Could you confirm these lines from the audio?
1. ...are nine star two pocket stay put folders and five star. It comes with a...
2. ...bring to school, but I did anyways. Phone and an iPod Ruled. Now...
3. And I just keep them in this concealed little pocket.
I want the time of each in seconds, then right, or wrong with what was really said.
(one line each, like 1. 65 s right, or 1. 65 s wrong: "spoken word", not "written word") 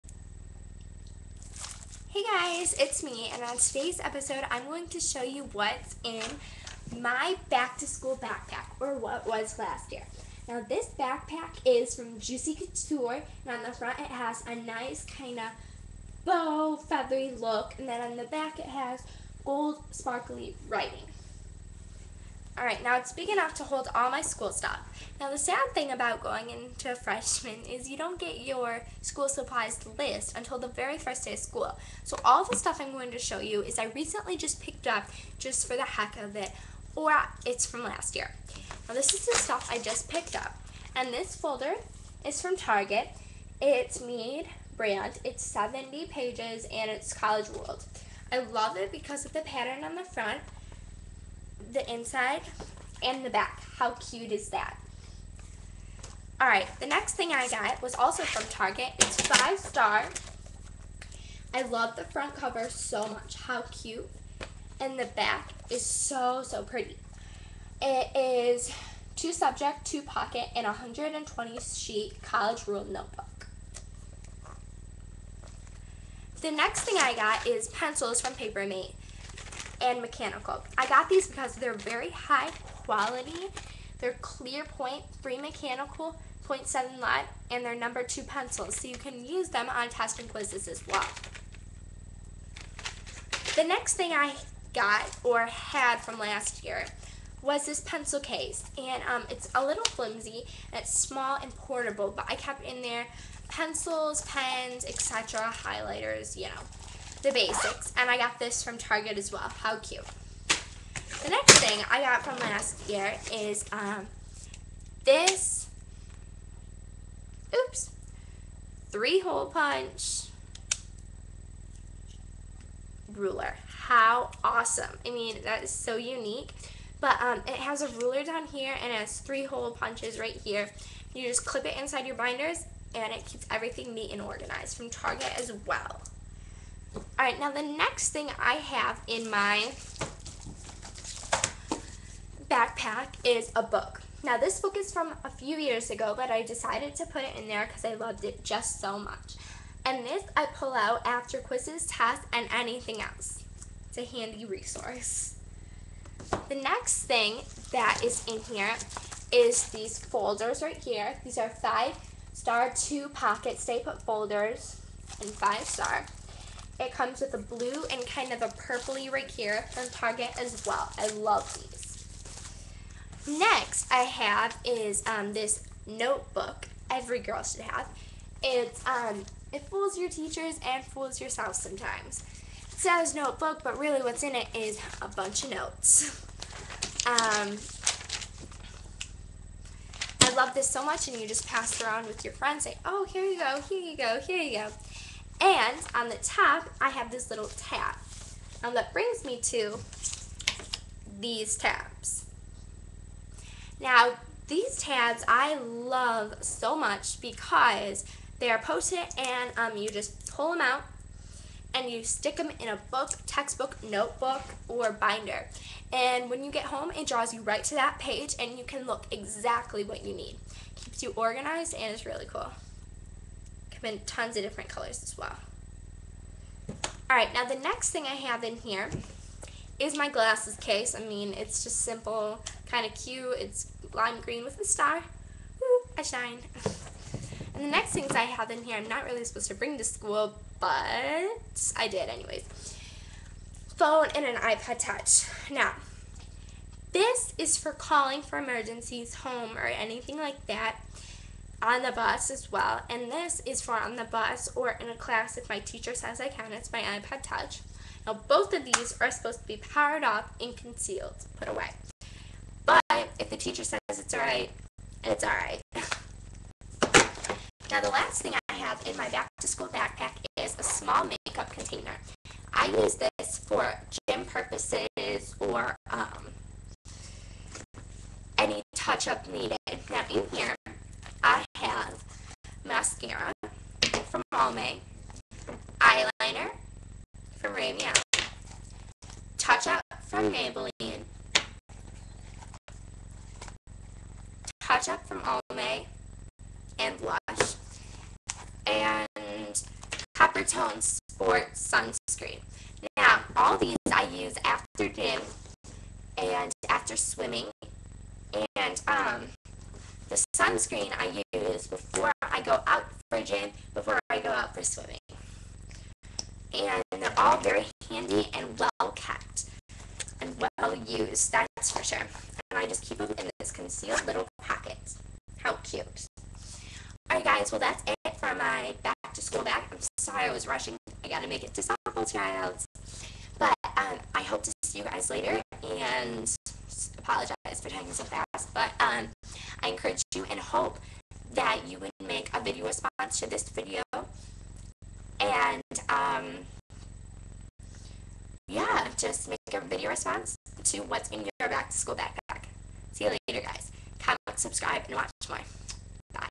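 1. 161 s wrong: "five", not "nine"
2. 239 s wrong: "Touch", not "Ruled"
3. 322 s right.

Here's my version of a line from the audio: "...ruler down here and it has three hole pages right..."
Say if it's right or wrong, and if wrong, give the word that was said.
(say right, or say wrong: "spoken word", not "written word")
wrong: "punches", not "pages".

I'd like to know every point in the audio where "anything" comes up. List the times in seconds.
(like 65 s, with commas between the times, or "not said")
152 s, 249 s.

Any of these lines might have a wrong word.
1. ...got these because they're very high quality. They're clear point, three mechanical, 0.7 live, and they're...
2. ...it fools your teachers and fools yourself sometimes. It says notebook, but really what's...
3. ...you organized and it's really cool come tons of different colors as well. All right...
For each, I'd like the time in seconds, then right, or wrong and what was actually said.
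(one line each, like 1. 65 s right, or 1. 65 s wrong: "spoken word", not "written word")
1. 80 s right
2. 179 s right
3. 221 s right.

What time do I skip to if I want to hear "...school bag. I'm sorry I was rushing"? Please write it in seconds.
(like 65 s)
329 s.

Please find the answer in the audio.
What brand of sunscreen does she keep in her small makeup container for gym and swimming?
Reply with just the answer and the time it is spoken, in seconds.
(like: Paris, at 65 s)
Coppertone Sport, at 300 s.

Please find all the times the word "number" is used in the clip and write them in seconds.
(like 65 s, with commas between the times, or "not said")
87 s.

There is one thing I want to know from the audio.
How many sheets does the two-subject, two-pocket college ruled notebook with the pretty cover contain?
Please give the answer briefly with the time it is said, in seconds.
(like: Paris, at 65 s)
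120, at 70 s.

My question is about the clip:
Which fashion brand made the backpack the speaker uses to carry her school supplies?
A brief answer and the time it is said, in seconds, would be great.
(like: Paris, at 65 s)
Juicy Couture, at 12 s.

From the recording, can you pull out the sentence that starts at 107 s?
And I got this from Target as well.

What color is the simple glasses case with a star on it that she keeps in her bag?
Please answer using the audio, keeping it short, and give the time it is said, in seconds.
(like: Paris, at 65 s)
lime green, at 233 s.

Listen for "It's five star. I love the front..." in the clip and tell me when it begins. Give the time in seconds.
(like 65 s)
58 s.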